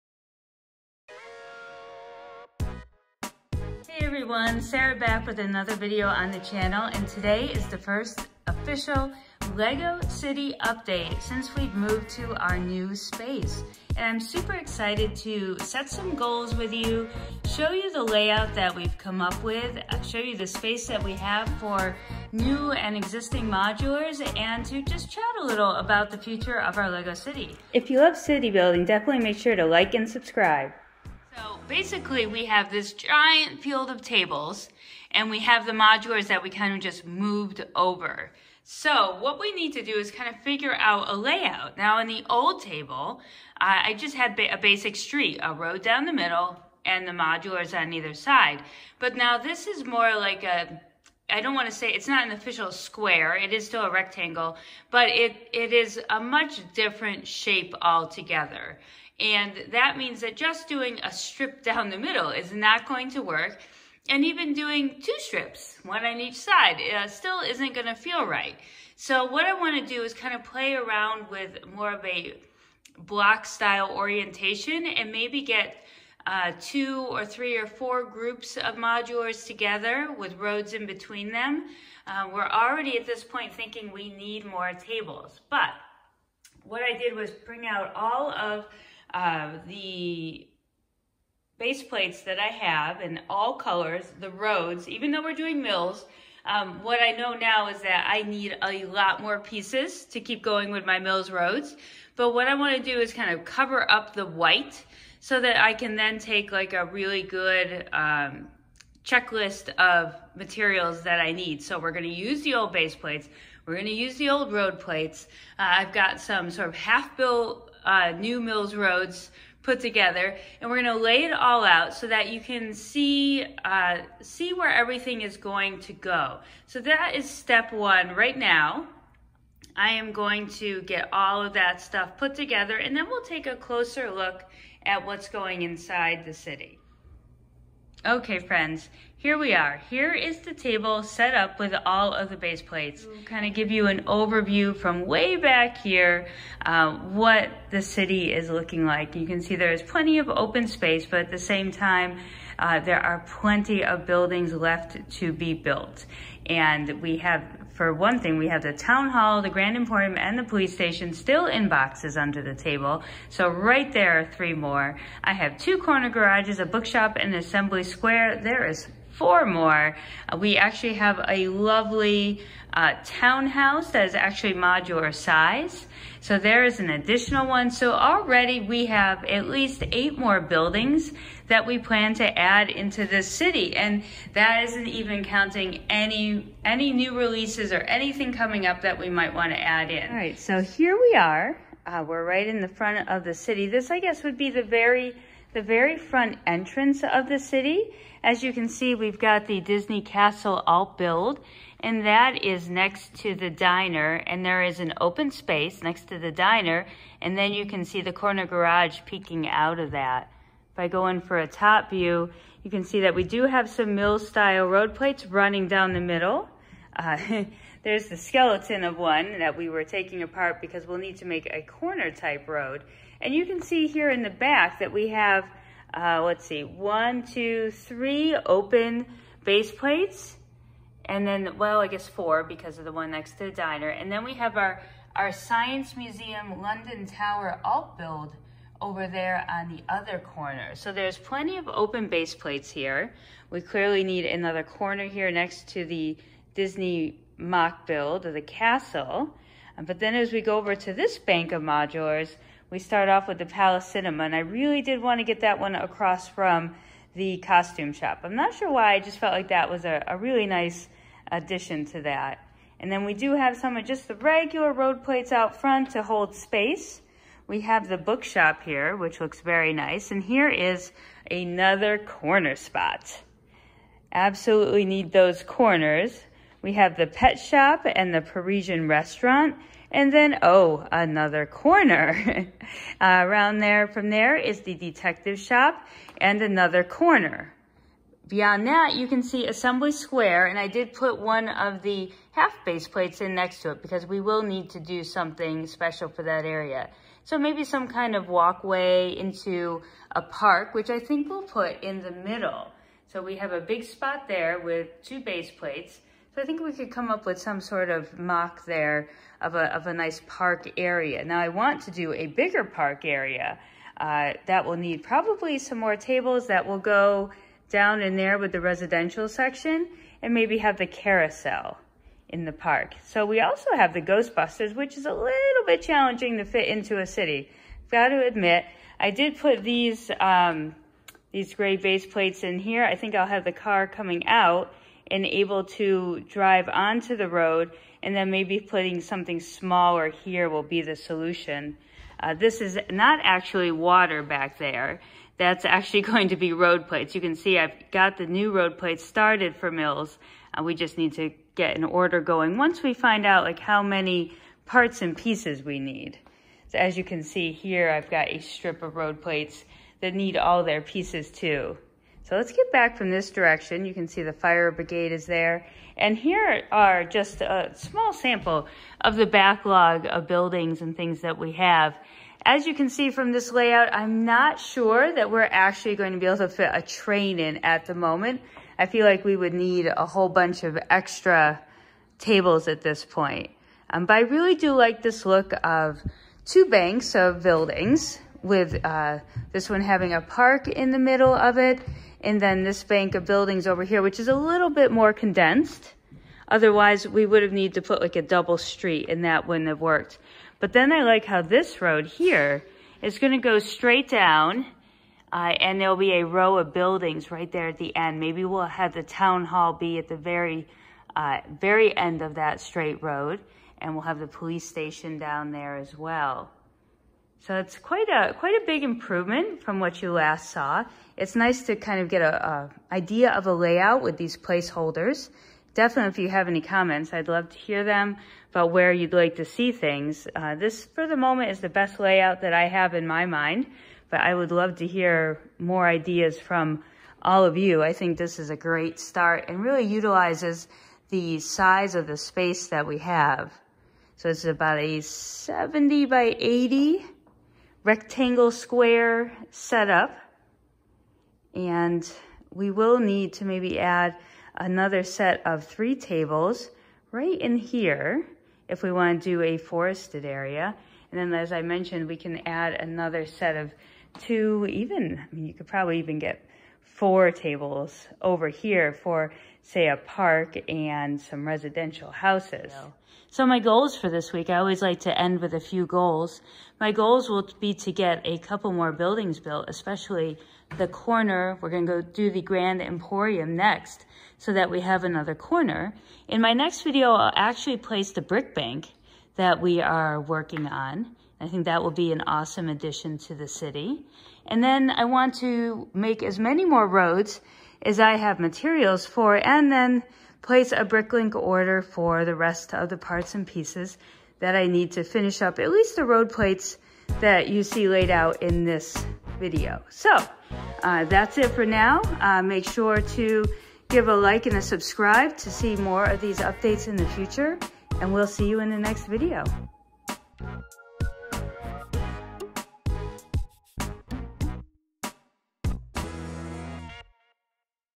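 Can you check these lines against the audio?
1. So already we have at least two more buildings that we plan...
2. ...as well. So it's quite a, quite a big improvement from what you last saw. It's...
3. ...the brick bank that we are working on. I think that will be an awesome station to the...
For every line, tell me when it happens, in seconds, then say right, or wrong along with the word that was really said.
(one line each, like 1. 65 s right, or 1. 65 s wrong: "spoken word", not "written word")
1. 177 s wrong: "eight", not "two"
2. 415 s right
3. 488 s wrong: "addition", not "station".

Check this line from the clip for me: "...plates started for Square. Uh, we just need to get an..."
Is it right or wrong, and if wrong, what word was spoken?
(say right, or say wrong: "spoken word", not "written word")
wrong: "MILS", not "Square".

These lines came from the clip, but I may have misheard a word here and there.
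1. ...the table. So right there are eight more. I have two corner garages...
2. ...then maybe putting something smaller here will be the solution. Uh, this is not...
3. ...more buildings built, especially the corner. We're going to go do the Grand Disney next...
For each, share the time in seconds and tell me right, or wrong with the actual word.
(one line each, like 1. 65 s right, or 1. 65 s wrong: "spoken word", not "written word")
1. 162 s wrong: "three", not "eight"
2. 338 s right
3. 478 s wrong: "Emporium", not "Disney".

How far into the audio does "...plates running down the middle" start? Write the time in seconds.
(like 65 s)
214 s.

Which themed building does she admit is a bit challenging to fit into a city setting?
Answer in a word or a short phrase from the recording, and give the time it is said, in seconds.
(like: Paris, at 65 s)
Ghostbusters, at 324 s.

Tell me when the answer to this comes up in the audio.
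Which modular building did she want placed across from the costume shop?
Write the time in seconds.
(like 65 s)
253 s.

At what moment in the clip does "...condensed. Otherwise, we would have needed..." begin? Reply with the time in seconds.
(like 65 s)
395 s.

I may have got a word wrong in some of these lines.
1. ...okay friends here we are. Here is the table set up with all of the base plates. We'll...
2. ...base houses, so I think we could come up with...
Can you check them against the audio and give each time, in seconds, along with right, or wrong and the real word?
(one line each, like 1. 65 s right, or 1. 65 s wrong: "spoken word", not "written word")
1. 138 s right
2. 305 s wrong: "plates", not "houses".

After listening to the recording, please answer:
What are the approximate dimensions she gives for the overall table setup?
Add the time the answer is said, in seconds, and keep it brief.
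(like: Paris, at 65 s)
70 by 80, at 445 s.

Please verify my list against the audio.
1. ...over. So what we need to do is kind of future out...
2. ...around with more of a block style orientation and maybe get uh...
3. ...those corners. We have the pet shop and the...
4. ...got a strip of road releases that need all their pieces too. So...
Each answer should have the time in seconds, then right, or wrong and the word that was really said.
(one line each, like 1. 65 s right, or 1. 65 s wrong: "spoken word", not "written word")
1. 37 s wrong: "figure", not "future"
2. 70 s right
3. 275 s right
4. 358 s wrong: "plates", not "releases".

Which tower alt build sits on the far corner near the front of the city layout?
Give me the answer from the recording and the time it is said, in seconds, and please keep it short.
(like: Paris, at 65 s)
Science Museum London Tower, at 235 s.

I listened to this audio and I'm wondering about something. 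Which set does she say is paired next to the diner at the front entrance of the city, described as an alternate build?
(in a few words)
Disney Castle.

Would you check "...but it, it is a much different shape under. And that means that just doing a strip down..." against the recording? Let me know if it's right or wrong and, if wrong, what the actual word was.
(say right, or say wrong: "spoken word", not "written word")
wrong: "altogether", not "under".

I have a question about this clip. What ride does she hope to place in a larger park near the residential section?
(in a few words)
carousel.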